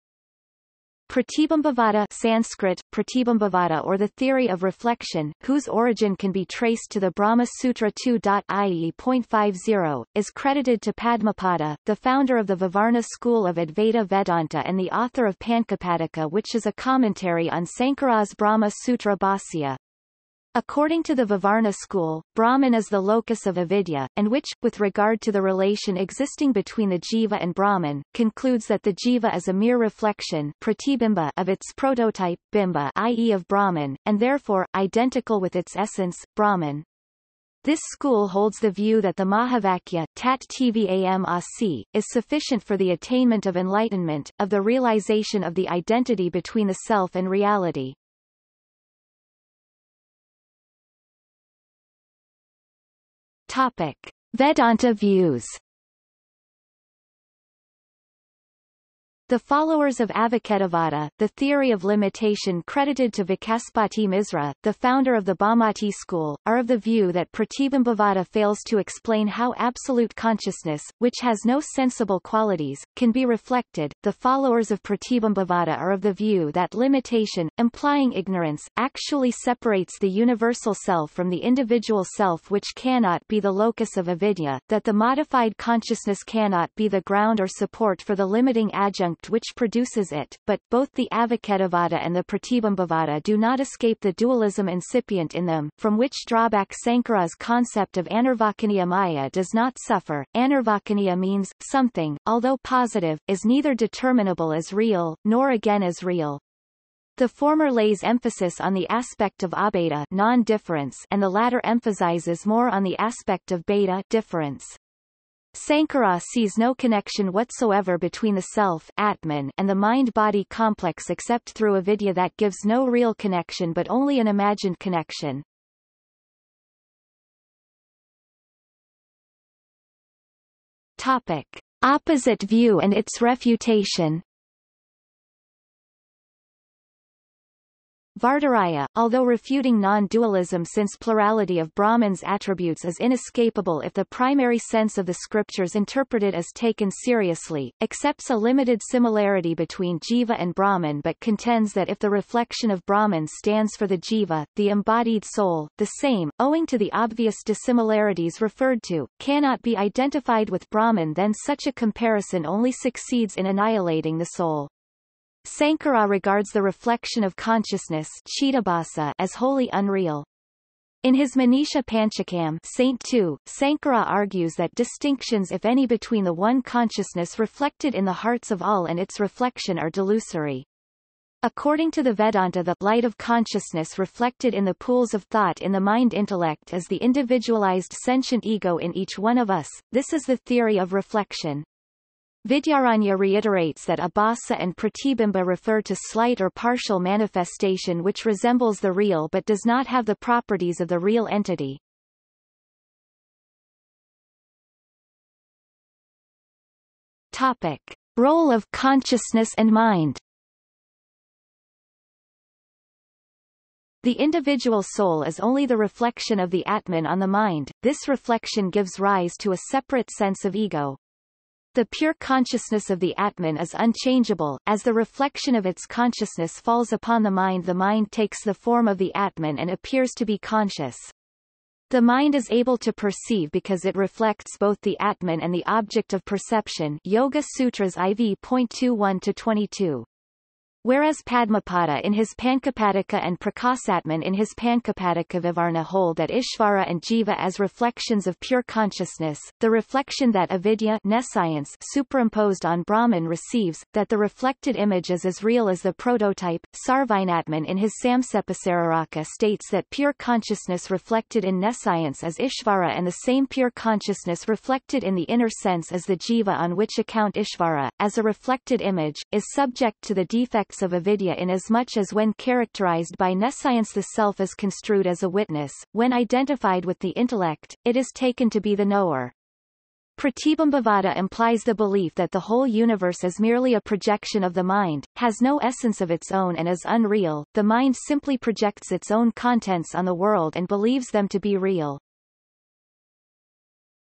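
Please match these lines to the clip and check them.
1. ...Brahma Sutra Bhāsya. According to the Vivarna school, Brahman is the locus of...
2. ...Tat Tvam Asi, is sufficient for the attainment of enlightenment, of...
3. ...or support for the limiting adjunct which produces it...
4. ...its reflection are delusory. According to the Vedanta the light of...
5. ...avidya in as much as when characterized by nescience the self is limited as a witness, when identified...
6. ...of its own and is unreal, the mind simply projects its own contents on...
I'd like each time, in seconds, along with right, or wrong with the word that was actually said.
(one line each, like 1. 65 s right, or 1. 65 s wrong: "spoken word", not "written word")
1. 18 s right
2. 40 s right
3. 87 s right
4. 178 s right
5. 270 s wrong: "construed", not "limited"
6. 285 s right.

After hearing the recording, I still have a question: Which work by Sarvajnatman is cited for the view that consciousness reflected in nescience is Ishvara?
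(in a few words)
Samksepasariraka.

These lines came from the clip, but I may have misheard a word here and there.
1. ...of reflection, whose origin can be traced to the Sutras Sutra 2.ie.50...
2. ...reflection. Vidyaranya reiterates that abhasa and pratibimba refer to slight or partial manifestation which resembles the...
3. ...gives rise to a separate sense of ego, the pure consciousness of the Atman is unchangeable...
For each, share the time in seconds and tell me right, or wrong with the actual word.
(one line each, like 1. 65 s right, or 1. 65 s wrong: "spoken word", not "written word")
1. 4 s wrong: "Brahma", not "Sutras"
2. 190 s right
3. 218 s right.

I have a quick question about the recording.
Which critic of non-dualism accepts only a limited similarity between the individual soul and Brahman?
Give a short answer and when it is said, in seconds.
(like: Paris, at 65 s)
Vadiraja, at 138 s.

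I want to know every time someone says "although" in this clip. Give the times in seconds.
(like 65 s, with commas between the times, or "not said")
102 s, 138 s.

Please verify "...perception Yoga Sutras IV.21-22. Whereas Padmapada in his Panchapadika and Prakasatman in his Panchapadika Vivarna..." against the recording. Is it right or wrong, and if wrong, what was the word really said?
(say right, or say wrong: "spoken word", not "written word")
right.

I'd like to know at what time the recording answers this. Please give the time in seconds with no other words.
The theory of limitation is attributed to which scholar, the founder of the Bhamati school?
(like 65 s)
63 s.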